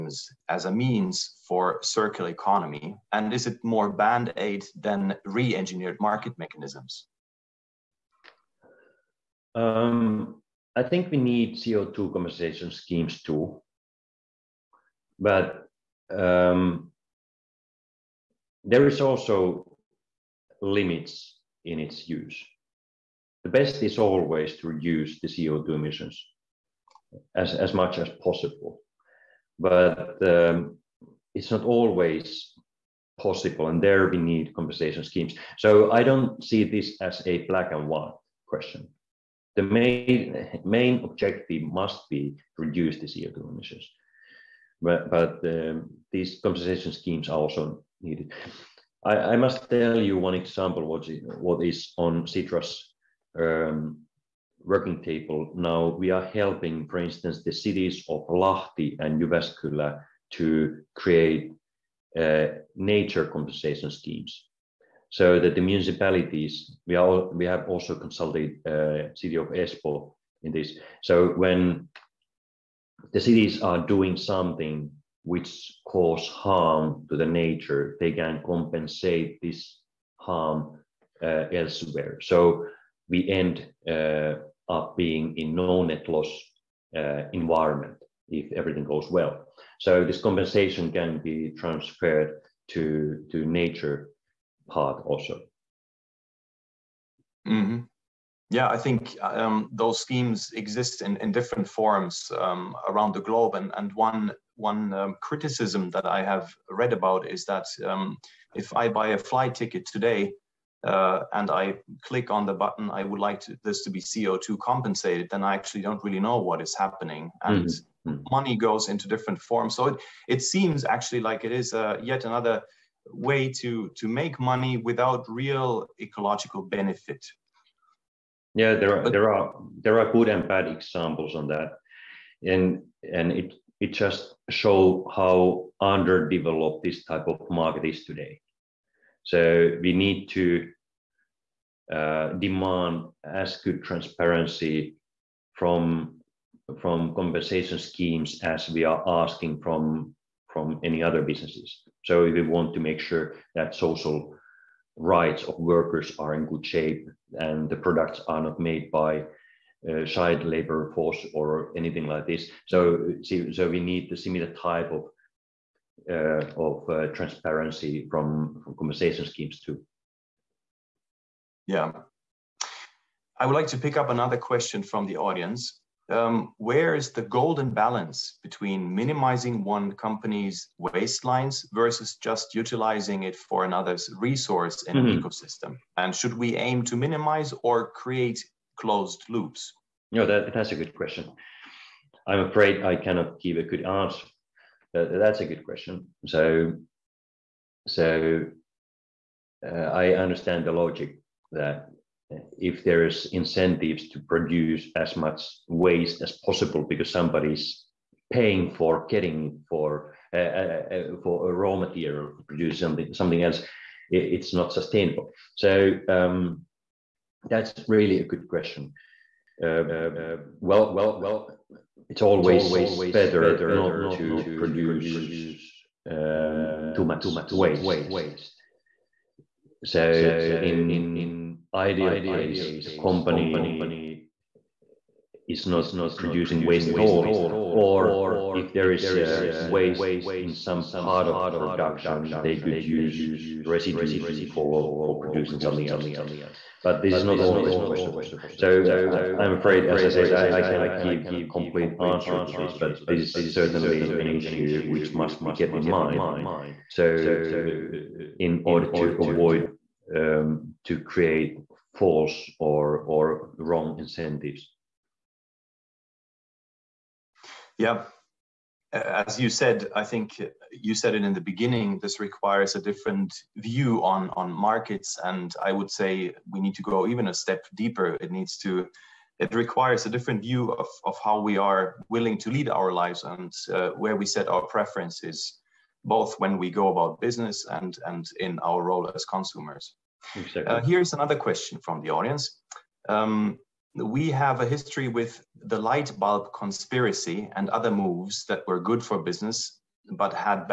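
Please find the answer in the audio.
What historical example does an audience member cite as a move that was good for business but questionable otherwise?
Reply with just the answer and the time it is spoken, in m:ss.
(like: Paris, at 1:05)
Light bulb conspiracy, at 4:55.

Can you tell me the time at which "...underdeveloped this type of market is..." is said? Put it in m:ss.
2:15.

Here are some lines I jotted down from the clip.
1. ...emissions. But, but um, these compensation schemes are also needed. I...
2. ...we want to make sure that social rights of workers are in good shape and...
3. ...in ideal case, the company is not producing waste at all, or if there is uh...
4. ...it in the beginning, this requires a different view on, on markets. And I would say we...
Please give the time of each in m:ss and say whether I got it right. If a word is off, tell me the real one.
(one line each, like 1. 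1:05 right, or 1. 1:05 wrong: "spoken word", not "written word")
1. 0:43 right
2. 2:32 right
3. 3:50 right
4. 4:31 right.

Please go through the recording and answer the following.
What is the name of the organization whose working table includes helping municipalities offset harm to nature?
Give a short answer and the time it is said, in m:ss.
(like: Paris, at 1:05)
Sitra, at 0:52.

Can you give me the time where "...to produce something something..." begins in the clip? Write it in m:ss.
3:32.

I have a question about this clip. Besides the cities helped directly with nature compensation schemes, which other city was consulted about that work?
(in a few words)
Espoo.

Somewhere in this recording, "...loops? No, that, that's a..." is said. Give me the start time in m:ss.
3:09.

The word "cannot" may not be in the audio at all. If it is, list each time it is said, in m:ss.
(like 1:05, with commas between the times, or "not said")
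3:13, 4:10.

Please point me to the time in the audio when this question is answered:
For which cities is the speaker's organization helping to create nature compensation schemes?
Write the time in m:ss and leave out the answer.
0:58.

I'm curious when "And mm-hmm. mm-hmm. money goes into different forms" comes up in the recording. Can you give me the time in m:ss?
1:57.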